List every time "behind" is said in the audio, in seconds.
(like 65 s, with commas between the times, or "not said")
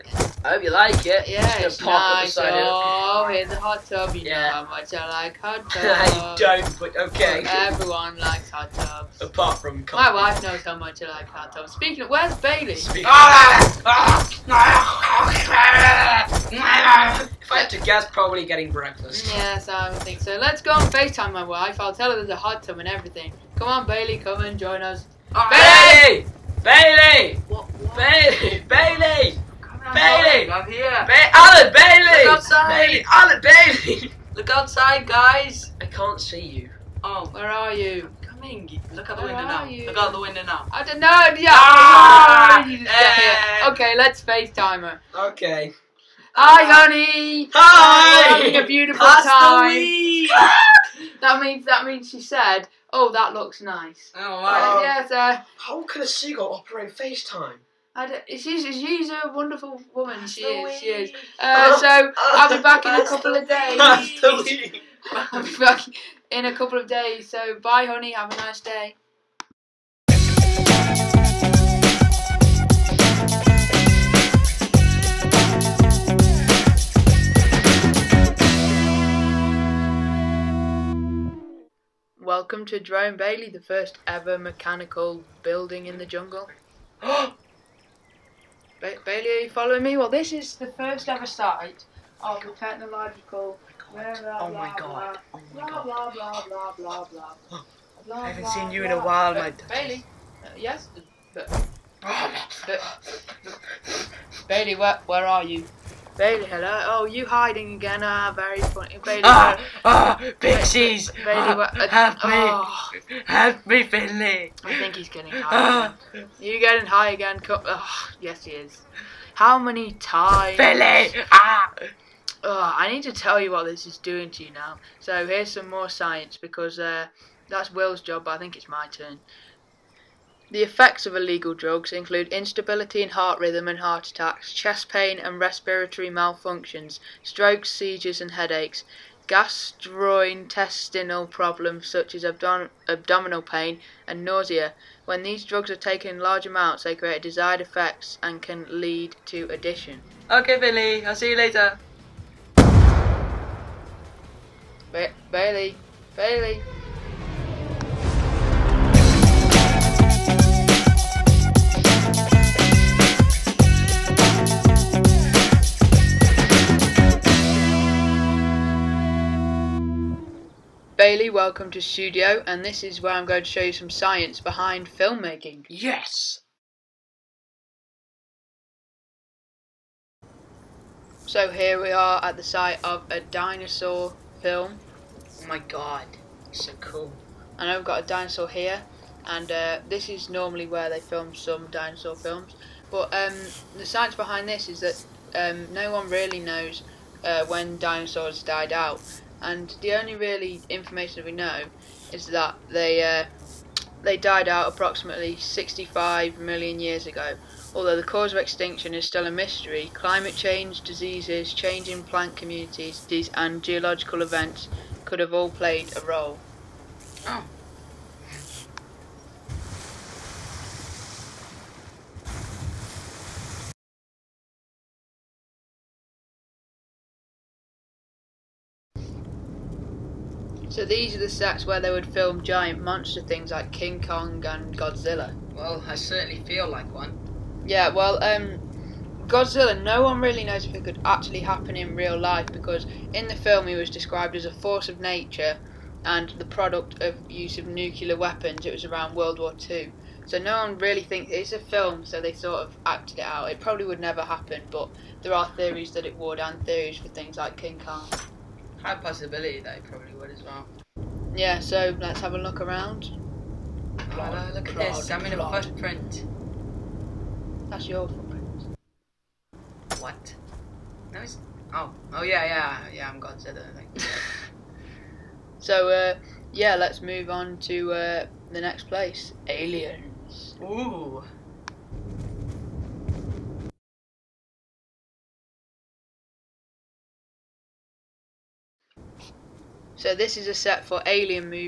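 174 s, 194 s.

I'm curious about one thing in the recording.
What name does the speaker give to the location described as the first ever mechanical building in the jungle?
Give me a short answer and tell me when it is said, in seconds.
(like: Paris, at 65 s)
Drone Bailey, at 82 s.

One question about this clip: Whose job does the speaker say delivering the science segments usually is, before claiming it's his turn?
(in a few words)
Will.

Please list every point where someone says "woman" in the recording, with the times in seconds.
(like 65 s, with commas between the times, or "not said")
59 s.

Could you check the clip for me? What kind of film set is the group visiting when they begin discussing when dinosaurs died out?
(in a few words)
a dinosaur film.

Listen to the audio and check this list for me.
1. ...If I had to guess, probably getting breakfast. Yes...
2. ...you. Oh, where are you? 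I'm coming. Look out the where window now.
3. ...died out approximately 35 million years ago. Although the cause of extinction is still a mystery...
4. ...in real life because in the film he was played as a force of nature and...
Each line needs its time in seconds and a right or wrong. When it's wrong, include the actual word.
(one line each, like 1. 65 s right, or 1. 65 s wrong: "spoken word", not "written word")
1. 17 s right
2. 36 s right
3. 204 s wrong: "65", not "35"
4. 241 s wrong: "described", not "played".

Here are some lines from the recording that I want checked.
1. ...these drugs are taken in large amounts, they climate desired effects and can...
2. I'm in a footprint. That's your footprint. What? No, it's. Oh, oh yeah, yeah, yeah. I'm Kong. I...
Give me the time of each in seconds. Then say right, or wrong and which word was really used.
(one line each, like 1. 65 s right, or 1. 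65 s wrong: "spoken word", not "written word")
1. 145 s wrong: "create", not "climate"
2. 265 s wrong: "Godzilla", not "Kong".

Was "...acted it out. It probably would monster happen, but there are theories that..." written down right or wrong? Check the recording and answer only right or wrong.
wrong.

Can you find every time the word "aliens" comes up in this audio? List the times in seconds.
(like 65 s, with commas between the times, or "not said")
279 s, 291 s.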